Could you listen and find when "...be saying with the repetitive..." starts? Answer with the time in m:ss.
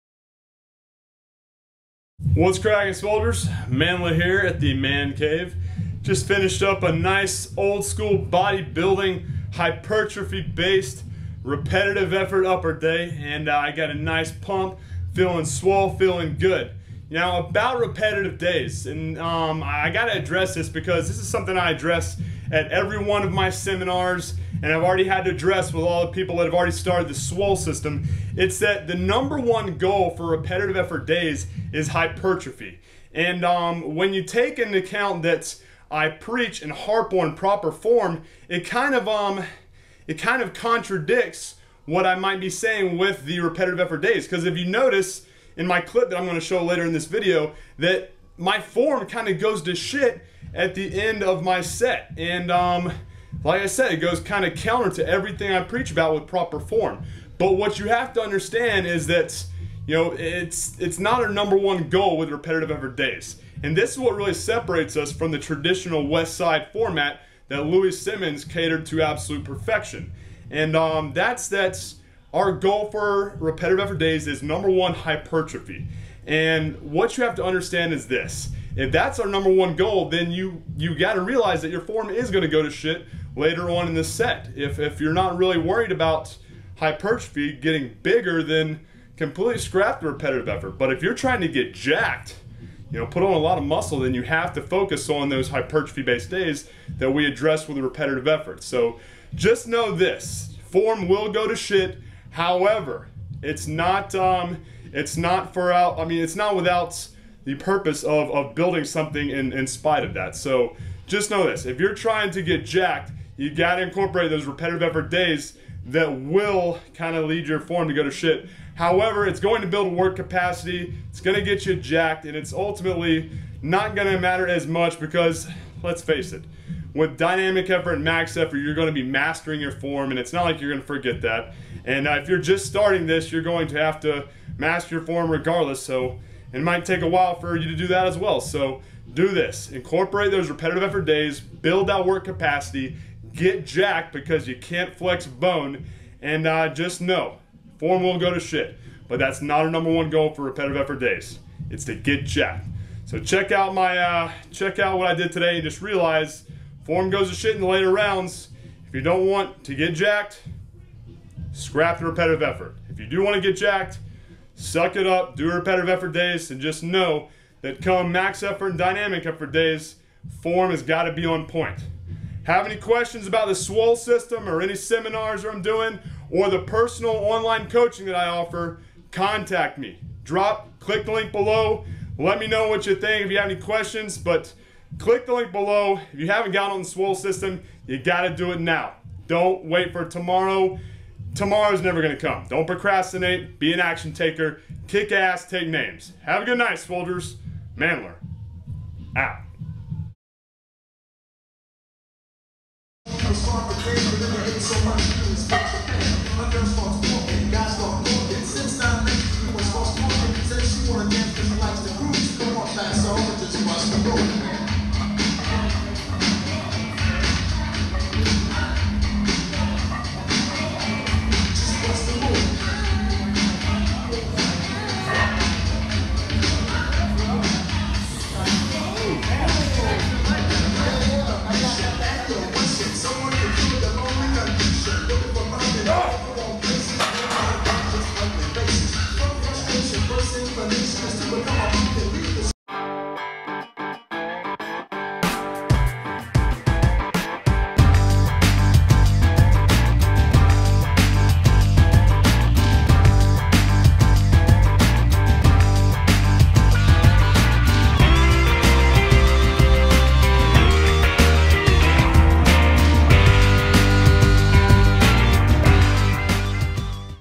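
0:42.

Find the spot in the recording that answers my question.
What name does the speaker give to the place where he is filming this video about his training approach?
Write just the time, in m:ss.
0:04.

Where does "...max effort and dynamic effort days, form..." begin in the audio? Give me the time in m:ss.
2:48.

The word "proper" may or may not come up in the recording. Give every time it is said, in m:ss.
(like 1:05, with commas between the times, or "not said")
0:37, 0:56.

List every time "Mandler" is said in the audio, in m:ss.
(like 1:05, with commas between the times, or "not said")
0:03, 3:17.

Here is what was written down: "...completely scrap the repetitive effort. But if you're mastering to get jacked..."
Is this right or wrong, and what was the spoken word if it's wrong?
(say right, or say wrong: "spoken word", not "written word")
wrong: "trying", not "mastering".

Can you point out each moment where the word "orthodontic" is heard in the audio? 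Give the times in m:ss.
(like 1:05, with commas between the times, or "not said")
not said.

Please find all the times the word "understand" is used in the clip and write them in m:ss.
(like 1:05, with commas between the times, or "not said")
0:58, 1:17.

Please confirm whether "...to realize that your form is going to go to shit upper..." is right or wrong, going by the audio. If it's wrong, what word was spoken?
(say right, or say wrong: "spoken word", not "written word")
wrong: "later", not "upper".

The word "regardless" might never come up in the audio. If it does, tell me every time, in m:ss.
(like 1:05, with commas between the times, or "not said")
2:15.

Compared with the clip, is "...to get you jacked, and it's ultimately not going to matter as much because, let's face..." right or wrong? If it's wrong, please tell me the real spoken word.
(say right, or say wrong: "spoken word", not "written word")
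right.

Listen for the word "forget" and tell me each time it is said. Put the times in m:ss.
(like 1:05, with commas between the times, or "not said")
2:10.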